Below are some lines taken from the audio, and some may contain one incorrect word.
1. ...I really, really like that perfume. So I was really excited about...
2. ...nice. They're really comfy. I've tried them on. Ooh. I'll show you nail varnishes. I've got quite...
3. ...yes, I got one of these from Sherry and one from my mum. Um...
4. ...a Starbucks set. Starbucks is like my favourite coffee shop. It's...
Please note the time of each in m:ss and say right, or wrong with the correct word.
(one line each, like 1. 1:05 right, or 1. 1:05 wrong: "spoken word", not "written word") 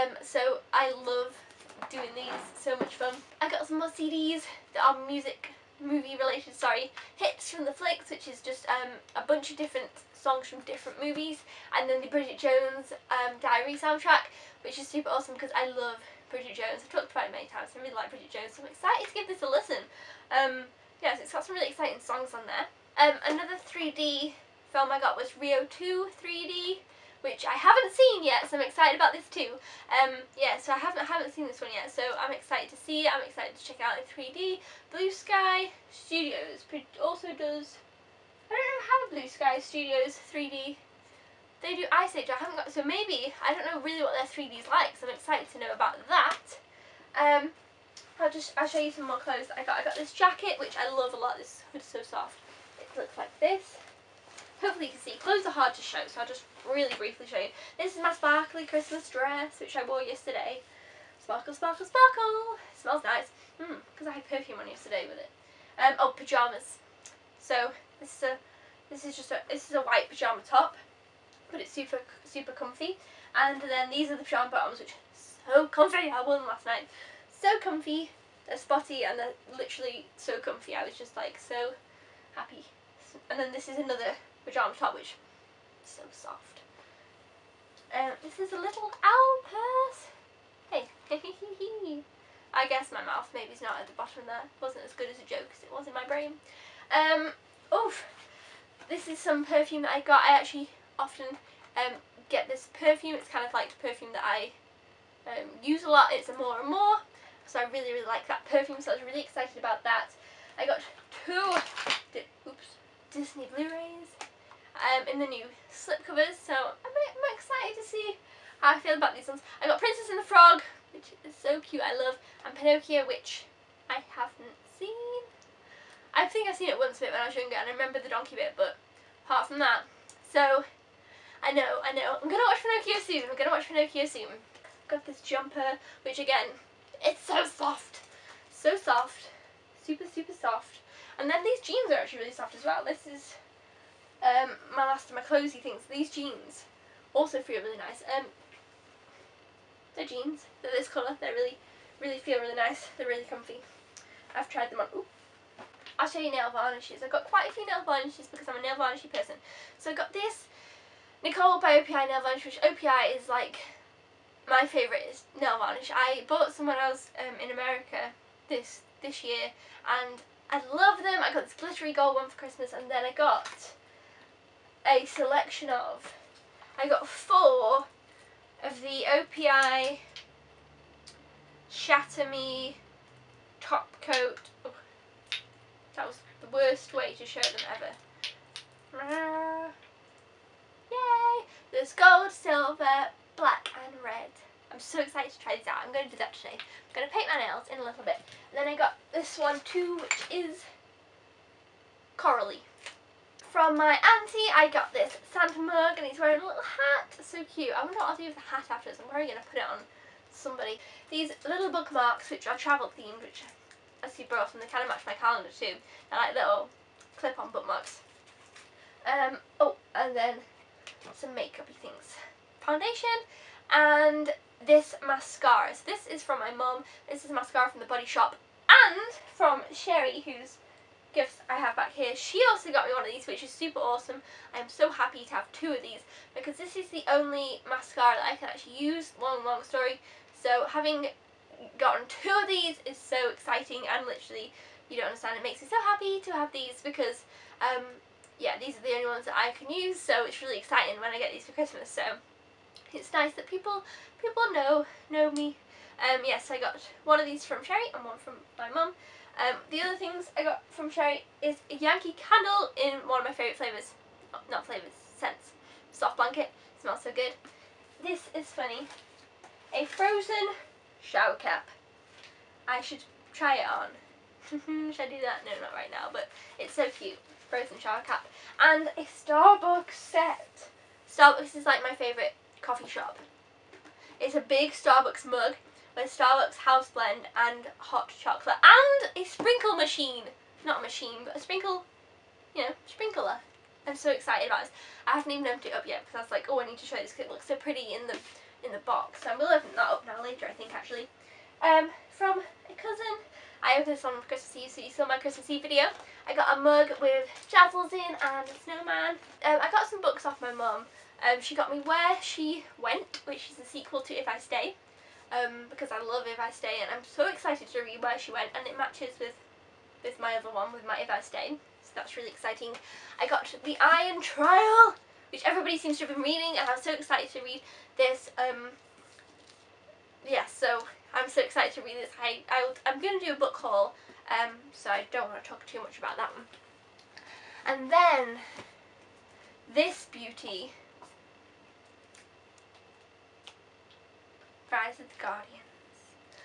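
1. 1:47 right
2. 2:32 right
3. 4:16 right
4. 4:38 right.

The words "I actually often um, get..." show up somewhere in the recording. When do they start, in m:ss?
1:40.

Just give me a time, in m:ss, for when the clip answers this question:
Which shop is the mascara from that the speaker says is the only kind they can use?
3:47.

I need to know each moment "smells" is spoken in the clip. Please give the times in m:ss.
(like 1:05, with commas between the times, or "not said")
1:02, 4:26.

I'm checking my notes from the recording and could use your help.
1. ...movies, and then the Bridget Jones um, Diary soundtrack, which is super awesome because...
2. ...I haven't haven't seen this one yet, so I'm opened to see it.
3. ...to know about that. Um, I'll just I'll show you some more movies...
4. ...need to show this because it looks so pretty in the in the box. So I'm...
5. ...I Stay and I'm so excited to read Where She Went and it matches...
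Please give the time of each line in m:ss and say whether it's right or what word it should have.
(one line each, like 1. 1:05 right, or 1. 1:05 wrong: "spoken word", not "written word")
1. 0:11 right
2. 0:30 wrong: "excited", not "opened"
3. 0:45 wrong: "clothes", not "movies"
4. 4:56 right
5. 5:16 right.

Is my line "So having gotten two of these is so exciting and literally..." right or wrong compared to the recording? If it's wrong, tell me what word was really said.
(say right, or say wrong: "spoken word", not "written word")
right.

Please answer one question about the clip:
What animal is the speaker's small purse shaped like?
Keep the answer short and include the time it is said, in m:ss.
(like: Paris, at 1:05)
Owl, at 1:29.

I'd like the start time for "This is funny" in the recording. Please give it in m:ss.
4:28.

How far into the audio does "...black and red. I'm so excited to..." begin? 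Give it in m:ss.
3:13.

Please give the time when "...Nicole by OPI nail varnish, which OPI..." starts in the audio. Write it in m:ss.
2:41.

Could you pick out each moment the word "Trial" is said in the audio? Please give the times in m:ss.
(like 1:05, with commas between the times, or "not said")
5:24.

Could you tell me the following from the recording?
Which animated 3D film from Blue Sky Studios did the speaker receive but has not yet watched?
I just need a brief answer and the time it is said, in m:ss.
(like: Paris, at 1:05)
Rio 2, at 0:25.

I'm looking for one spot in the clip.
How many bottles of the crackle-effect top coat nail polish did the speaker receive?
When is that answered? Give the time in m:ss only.
2:57.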